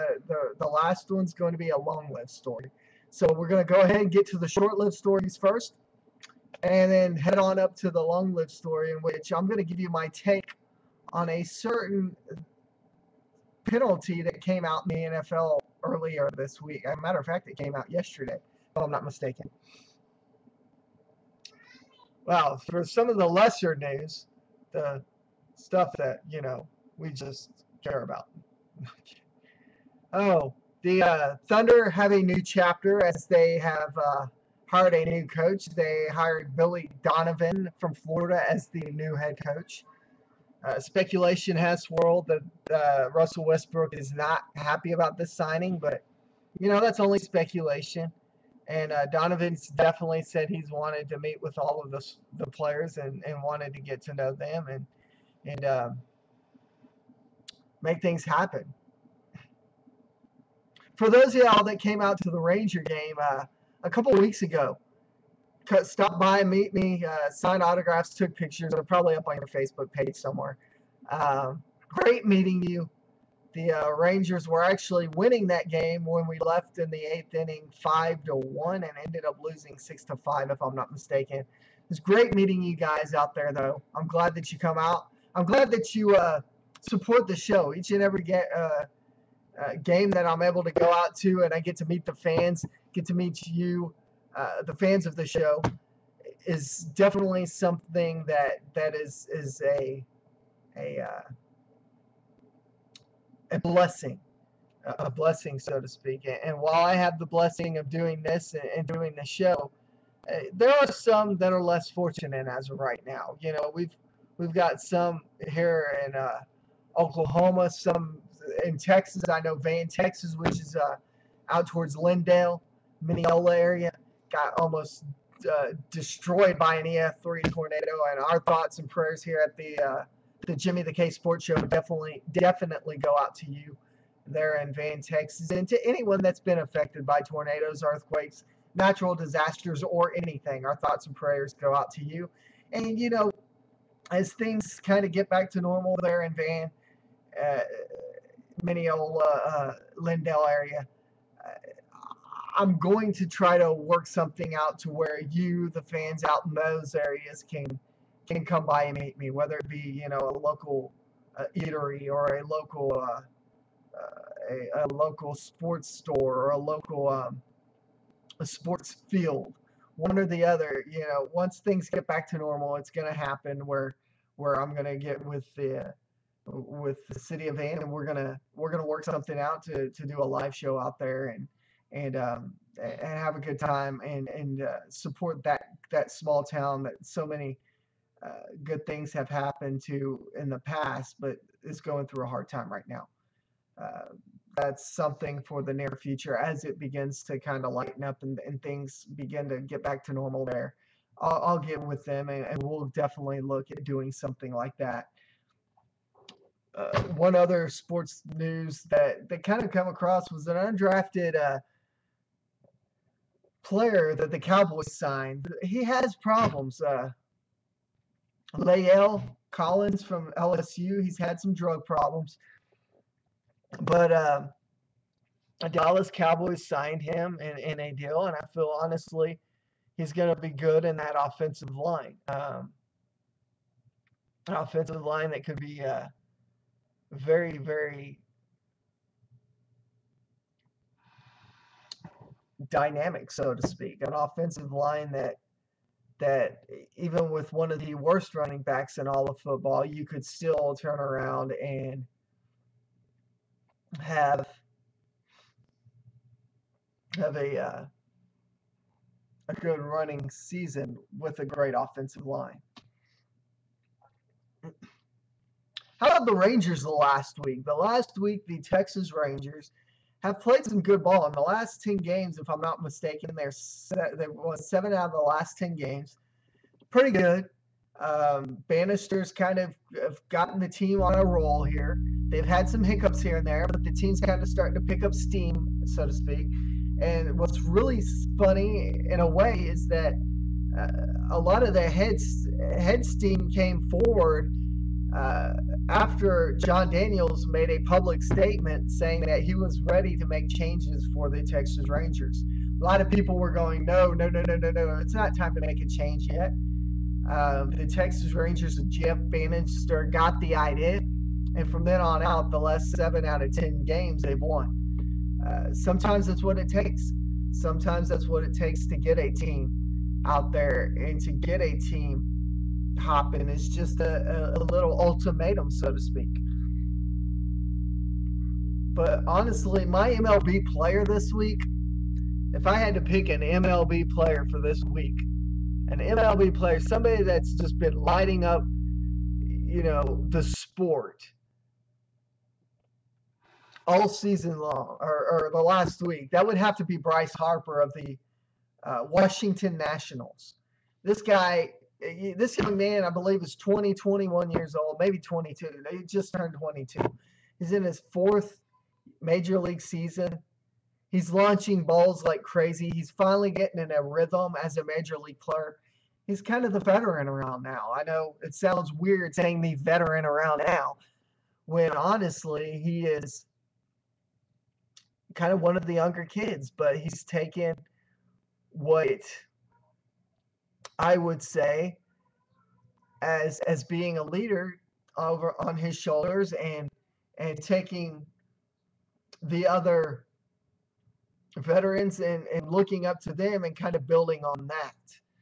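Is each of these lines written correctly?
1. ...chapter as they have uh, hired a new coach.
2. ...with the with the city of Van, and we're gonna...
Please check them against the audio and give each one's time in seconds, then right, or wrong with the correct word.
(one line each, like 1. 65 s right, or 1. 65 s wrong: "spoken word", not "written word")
1. 32 s right
2. 175 s right.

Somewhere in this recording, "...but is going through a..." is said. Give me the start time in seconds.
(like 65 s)
191 s.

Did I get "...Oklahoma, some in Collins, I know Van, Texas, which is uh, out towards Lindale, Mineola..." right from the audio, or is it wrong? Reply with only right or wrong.
wrong.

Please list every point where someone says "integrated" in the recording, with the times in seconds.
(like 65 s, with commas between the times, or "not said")
not said.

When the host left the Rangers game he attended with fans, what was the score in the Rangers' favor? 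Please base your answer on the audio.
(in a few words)
5 to 1.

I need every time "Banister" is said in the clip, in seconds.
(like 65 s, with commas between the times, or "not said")
278 s, 309 s.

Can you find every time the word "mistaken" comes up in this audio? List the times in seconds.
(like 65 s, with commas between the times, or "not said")
19 s, 80 s, 272 s.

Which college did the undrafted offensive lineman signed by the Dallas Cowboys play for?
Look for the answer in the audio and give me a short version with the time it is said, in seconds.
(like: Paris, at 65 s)
LSU, at 220 s.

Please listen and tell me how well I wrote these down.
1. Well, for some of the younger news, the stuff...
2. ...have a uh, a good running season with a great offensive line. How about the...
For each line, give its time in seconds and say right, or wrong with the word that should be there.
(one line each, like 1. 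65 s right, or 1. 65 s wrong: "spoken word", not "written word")
1. 22 s wrong: "lesser", not "younger"
2. 257 s right.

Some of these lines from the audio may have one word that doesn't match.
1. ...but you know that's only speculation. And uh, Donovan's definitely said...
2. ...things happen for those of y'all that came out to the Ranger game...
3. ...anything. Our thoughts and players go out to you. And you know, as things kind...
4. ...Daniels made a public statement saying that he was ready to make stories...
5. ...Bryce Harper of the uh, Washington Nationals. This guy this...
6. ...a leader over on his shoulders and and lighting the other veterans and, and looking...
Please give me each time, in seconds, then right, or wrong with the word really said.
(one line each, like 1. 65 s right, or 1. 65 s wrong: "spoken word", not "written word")
1. 45 s right
2. 58 s right
3. 140 s wrong: "prayers", not "players"
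4. 296 s wrong: "changes", not "stories"
5. 346 s right
6. 384 s wrong: "taking", not "lighting".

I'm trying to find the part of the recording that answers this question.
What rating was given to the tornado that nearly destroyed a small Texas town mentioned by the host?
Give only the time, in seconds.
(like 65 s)
126 s.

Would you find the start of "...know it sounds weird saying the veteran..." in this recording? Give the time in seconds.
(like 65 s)
368 s.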